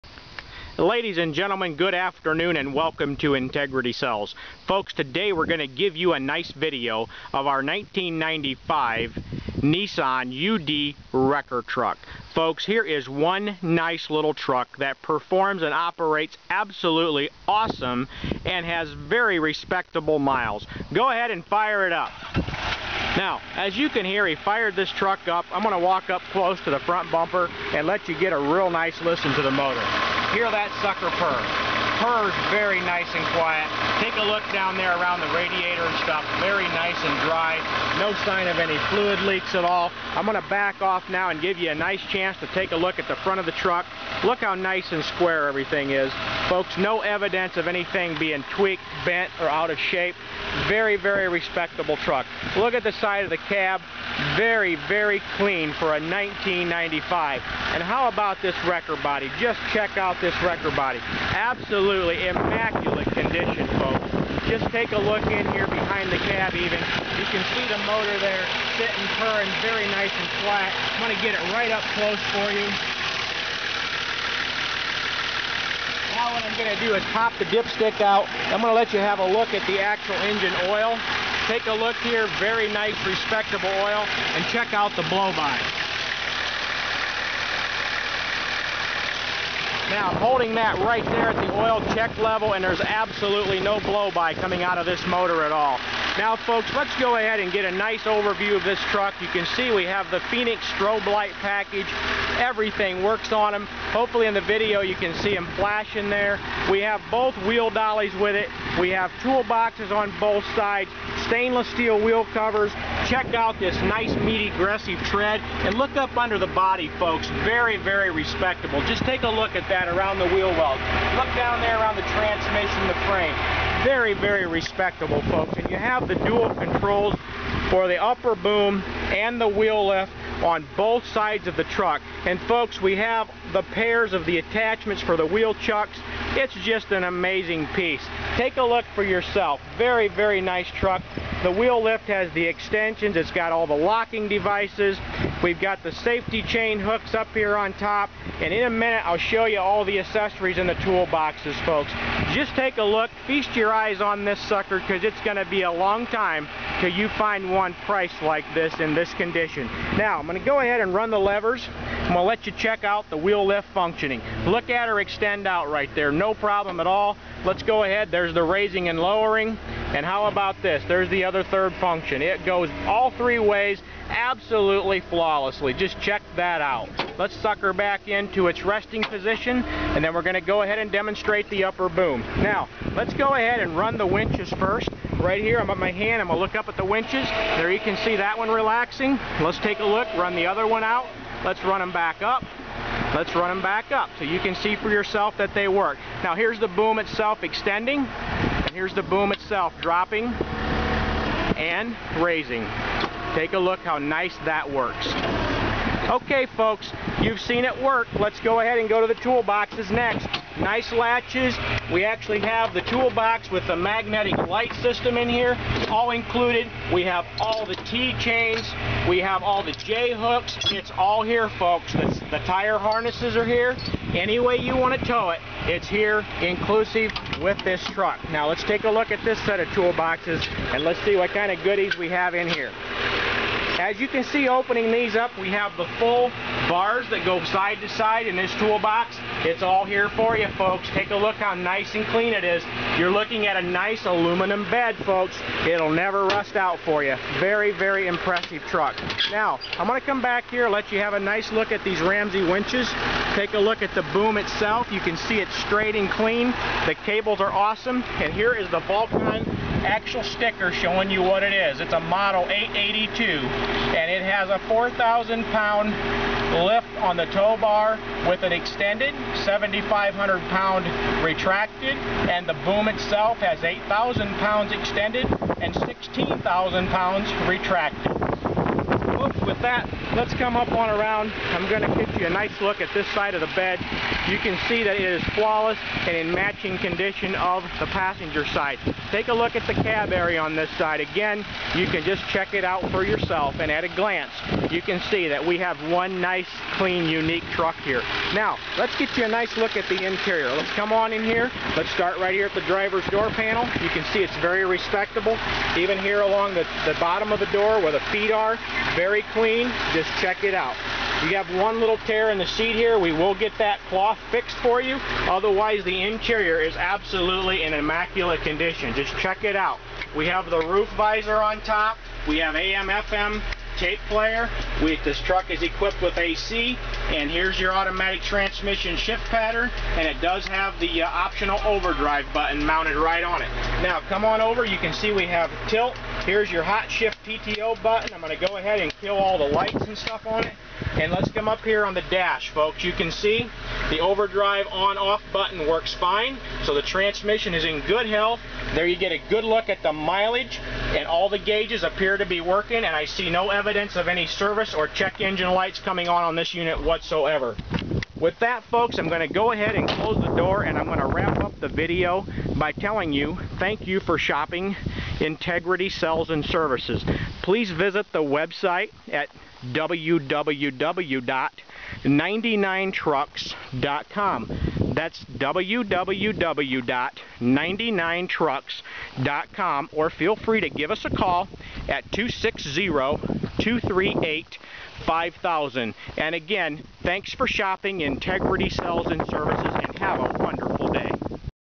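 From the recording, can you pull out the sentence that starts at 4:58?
Now, let's get you a nice look at the interior.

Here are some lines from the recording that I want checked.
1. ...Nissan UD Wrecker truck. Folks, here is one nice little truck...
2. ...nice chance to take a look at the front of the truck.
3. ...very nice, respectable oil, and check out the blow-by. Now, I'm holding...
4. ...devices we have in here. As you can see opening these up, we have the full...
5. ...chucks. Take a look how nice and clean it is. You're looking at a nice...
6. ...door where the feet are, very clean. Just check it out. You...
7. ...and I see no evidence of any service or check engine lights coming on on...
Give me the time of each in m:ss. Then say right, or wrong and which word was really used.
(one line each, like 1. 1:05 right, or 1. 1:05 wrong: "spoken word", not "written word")
1. 0:09 right
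2. 0:41 right
3. 1:22 right
4. 3:51 wrong: "goodies", not "devices"
5. 4:00 wrong: "folks", not "chucks"
6. 5:07 right
7. 5:52 right.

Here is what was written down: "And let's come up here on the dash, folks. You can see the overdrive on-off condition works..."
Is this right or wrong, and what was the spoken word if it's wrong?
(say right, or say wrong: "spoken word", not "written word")
wrong: "button", not "condition".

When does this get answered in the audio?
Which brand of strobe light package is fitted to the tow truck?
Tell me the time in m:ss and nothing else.
1:40.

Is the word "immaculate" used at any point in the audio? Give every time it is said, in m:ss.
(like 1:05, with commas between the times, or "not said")
1:02, 5:17.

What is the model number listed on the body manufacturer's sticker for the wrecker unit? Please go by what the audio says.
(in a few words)
882.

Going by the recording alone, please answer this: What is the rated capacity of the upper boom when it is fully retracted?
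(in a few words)
16,000 pounds.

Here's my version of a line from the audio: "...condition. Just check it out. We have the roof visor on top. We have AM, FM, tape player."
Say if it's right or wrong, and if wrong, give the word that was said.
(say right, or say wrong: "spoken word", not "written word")
right.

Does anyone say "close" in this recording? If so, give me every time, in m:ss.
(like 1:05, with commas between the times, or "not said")
0:26, 1:11, 5:59.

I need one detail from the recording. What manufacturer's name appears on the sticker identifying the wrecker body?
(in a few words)
Vulcan.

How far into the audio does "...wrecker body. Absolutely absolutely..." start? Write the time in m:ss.
1:00.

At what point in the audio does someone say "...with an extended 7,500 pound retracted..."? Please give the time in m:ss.
4:28.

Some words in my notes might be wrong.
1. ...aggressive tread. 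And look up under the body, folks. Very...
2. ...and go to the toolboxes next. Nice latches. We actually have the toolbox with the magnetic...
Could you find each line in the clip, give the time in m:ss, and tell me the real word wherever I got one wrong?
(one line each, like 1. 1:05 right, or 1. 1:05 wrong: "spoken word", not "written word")
1. 1:54 right
2. 3:28 right.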